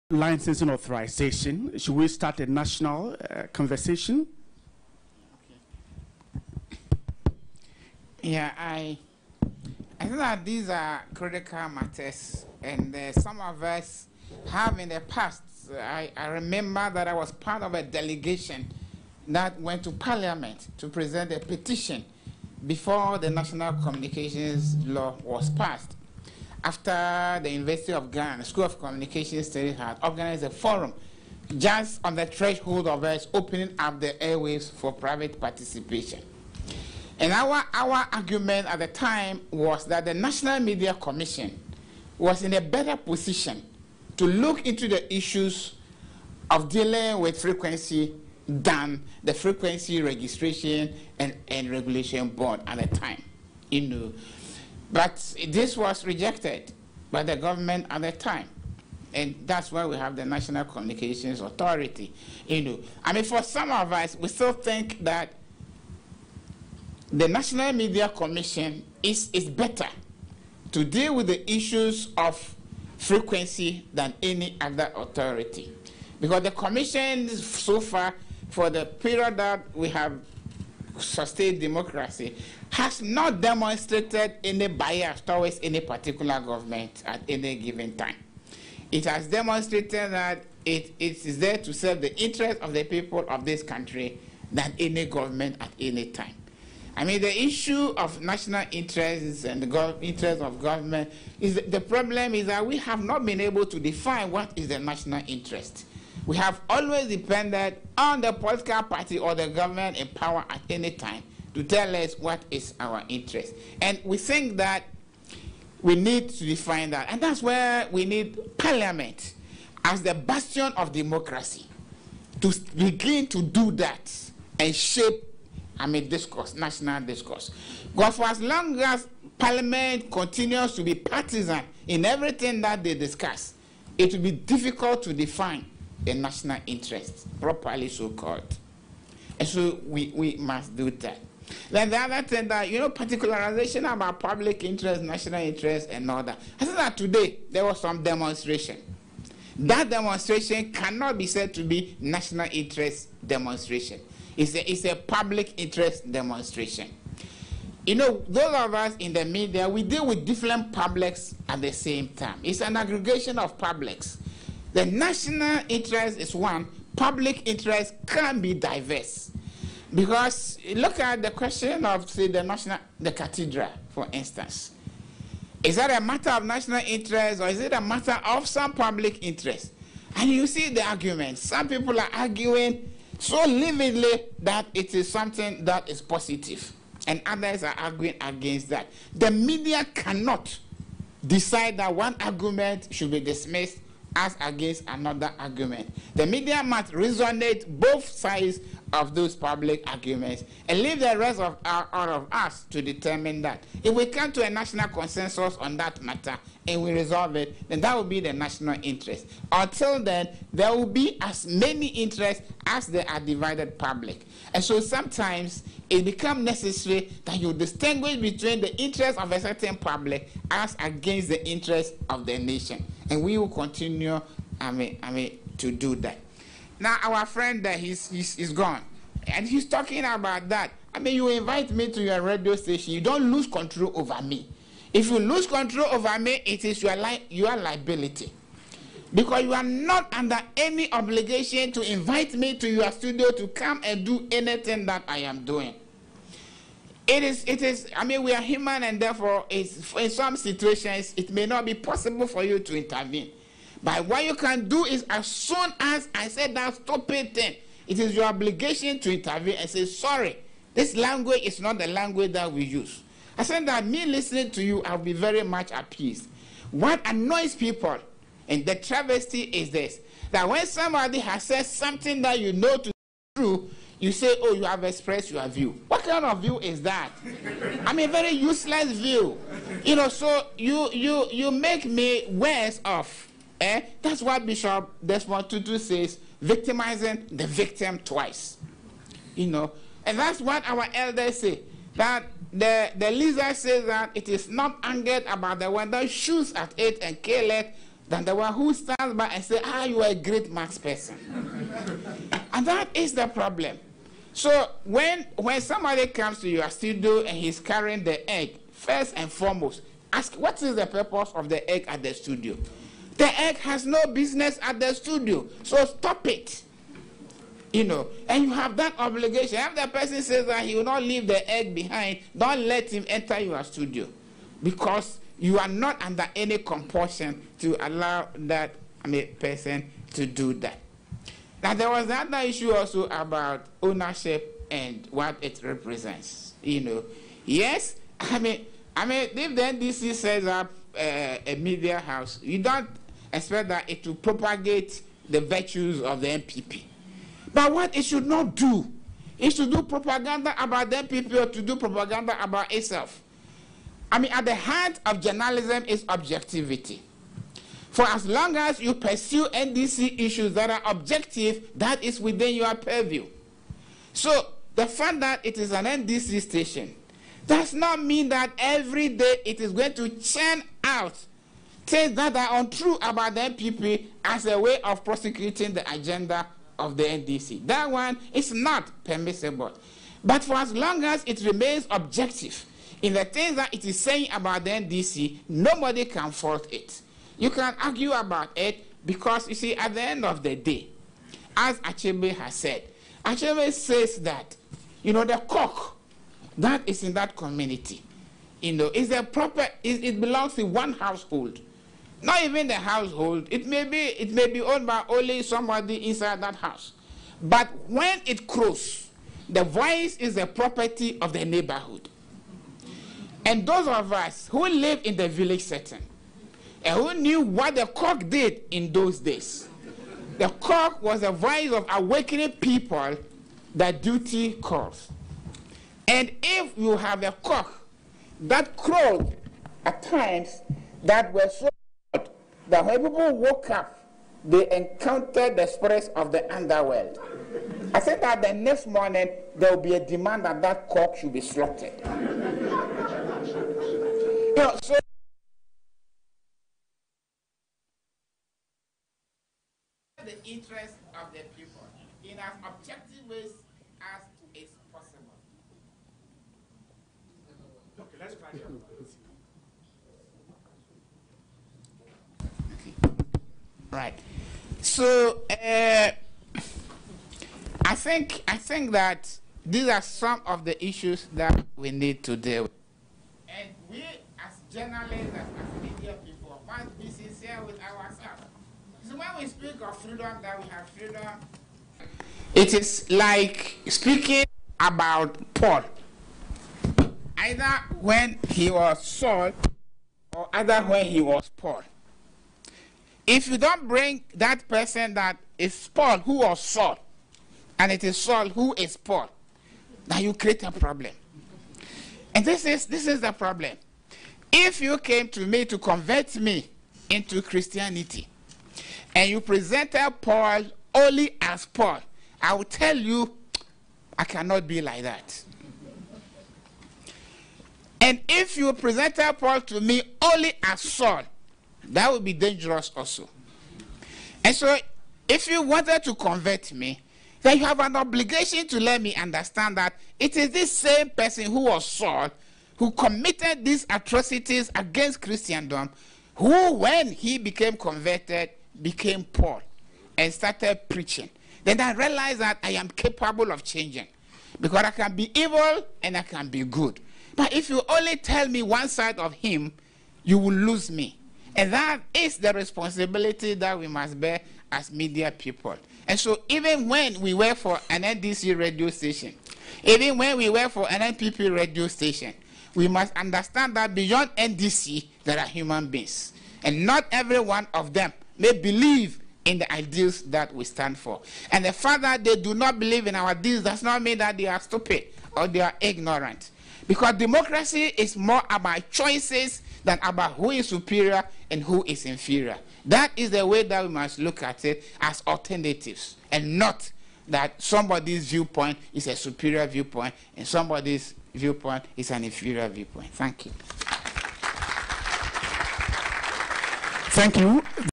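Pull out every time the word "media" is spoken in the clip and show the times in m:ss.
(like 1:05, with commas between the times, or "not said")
0:40, 1:07, 2:39, 3:09, 3:16, 5:41, 9:14.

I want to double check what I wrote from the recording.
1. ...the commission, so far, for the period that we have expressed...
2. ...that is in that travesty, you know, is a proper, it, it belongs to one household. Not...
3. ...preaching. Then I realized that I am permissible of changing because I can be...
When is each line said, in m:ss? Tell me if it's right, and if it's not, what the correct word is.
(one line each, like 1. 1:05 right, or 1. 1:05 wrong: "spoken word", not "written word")
1. 1:16 wrong: "sustained", not "expressed"
2. 6:36 wrong: "community", not "travesty"
3. 9:00 wrong: "capable", not "permissible".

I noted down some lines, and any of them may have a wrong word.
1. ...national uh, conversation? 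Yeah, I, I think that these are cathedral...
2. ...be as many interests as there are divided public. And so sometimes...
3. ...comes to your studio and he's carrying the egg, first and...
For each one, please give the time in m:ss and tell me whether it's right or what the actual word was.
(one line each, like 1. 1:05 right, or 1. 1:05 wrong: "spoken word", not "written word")
1. 0:02 wrong: "critical", not "cathedral"
2. 3:30 right
3. 5:06 right.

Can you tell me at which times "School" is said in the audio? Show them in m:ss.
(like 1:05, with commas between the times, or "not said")
0:28.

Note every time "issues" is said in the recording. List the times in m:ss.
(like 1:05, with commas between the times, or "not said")
0:45, 1:11, 1:37, 5:32, 6:00, 7:50.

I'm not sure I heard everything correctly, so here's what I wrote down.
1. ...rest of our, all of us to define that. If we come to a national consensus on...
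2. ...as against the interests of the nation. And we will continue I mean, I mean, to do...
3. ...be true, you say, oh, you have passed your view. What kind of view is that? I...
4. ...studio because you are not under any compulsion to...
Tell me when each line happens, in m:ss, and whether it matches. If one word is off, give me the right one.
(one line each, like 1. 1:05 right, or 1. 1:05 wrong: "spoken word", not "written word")
1. 3:21 wrong: "determine", not "define"
2. 3:40 right
3. 4:32 wrong: "expressed", not "passed"
4. 5:23 right.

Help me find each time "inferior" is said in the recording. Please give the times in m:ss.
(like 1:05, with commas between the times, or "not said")
9:42, 9:52.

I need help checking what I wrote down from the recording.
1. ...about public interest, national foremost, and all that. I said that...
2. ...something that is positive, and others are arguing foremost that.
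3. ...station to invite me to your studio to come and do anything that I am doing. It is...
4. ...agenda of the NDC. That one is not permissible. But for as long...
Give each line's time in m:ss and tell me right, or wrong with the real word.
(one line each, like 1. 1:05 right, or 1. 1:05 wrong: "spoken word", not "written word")
1. 2:23 wrong: "interest", not "foremost"
2. 3:05 wrong: "against", not "foremost"
3. 4:00 wrong: "obligation", not "station"
4. 6:15 right.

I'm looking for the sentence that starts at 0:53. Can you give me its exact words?
You know, but this was rejected by the government at the time.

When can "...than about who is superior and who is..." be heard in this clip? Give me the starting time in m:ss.
9:39.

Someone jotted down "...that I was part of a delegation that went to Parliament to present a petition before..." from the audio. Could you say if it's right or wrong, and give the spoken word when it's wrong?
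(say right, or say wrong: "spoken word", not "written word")
right.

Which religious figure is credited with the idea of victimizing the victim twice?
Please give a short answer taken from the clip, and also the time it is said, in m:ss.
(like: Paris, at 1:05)
Desmond Tutu, at 4:45.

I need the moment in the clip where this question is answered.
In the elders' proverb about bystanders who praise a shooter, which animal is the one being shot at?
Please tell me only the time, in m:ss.
4:53.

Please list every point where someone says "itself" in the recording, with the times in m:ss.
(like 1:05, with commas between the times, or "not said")
5:52.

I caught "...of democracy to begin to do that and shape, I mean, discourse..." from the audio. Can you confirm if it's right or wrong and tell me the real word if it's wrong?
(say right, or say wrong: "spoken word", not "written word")
right.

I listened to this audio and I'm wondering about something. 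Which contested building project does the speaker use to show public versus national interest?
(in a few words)
The cathedral.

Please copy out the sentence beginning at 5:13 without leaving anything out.
The egg has no business at the studio, so stop it.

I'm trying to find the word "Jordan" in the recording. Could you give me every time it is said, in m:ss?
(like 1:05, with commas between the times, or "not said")
not said.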